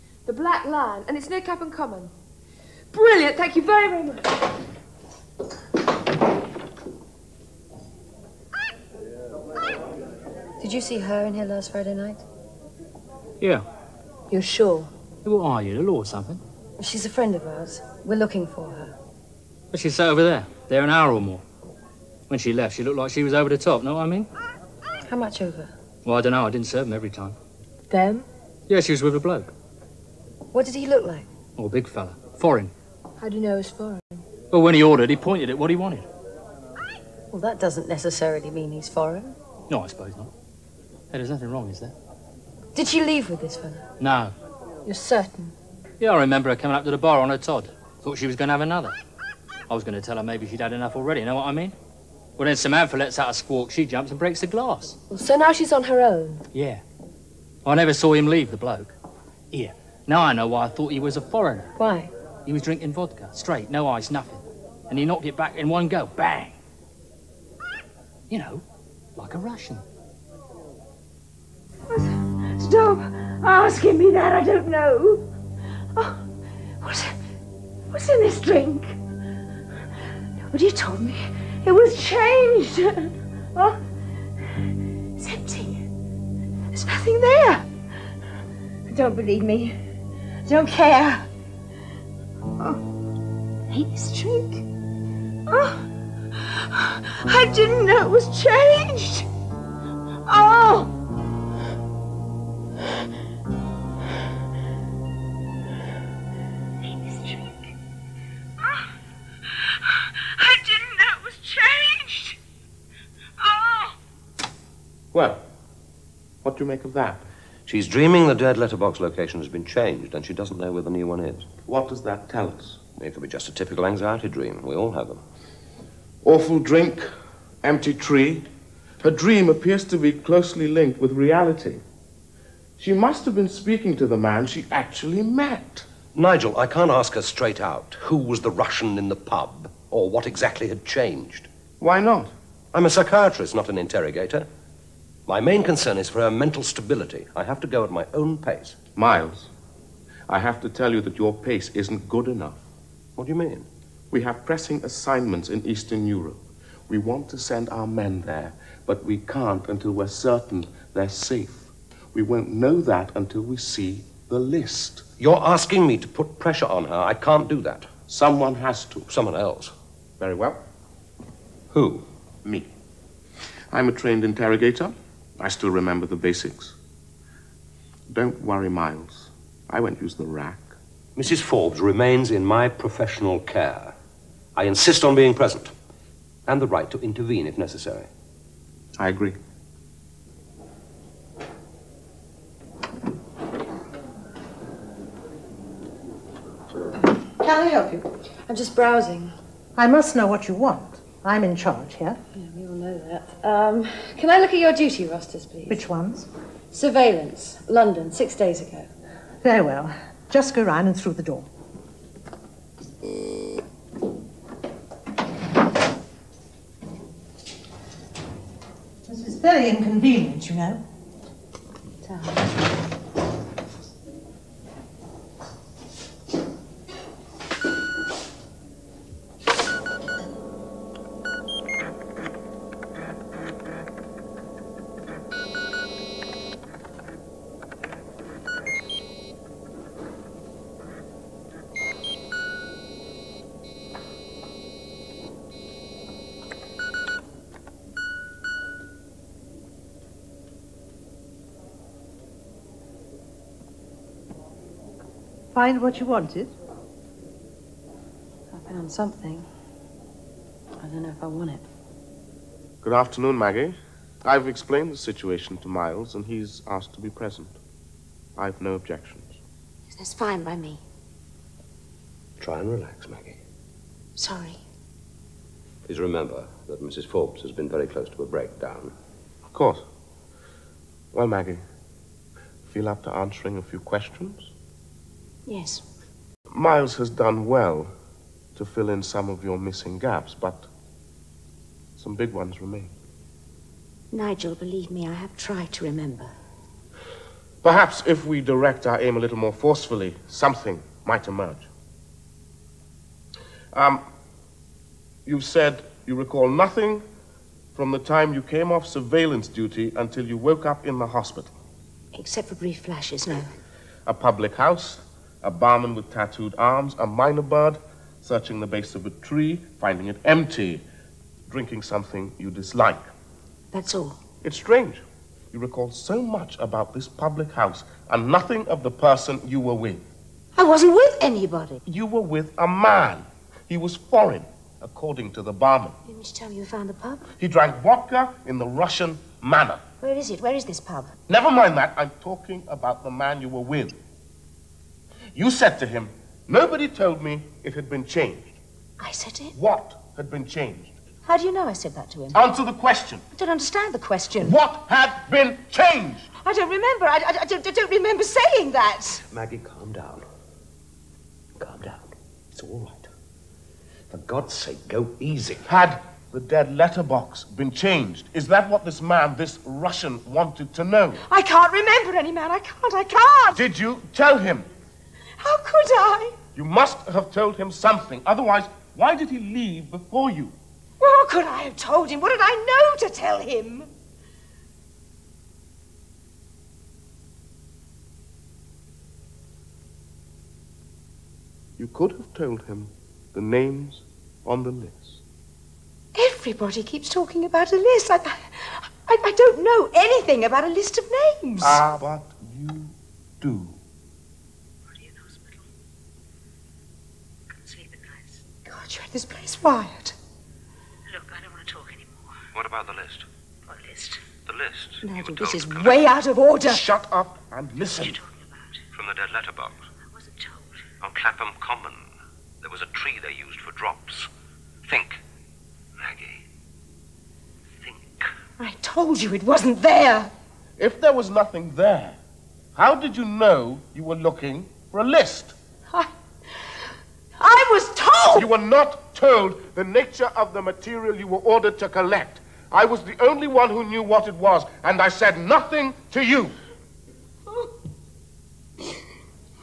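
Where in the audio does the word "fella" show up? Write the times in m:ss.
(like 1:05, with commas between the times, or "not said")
0:31, 0:43.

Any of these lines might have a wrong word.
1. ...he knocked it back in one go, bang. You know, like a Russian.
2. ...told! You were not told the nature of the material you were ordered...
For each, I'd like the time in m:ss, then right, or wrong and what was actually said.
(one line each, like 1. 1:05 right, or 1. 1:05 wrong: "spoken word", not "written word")
1. 1:04 right
2. 7:17 right.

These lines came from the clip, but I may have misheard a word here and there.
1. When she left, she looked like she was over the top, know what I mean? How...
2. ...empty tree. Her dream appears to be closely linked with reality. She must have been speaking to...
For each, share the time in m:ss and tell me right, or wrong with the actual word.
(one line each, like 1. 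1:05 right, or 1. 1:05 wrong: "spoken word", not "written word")
1. 0:22 right
2. 2:07 right.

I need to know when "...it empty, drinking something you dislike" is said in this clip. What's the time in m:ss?
5:20.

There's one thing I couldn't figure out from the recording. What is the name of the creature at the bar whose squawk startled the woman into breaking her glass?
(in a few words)
Samantha.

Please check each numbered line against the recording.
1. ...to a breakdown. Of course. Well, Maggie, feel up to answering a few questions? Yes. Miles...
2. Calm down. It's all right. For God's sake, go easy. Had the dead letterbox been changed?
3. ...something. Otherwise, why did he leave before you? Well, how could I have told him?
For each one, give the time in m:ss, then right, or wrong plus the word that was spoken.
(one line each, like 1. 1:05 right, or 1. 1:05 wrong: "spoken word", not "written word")
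1. 4:38 right
2. 6:01 right
3. 6:17 right.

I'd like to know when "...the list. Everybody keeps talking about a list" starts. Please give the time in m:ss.
6:34.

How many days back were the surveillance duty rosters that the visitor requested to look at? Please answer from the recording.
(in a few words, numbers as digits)
6.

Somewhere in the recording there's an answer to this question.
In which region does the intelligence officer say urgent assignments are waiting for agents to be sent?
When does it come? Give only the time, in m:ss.
2:35.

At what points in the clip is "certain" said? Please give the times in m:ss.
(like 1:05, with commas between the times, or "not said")
0:44, 2:40.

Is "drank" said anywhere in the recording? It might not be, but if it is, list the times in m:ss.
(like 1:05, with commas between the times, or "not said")
5:37.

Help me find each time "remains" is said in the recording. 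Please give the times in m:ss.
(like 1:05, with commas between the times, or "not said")
3:01, 4:52.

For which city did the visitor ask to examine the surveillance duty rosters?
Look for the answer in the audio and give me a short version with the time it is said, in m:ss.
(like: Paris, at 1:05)
London, at 3:27.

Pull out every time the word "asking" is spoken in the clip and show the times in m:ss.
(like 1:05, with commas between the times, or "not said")
1:13, 2:45.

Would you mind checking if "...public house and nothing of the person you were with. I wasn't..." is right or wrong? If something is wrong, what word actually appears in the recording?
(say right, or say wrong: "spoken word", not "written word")
right.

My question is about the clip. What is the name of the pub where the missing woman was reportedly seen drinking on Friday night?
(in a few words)
The Black Lion.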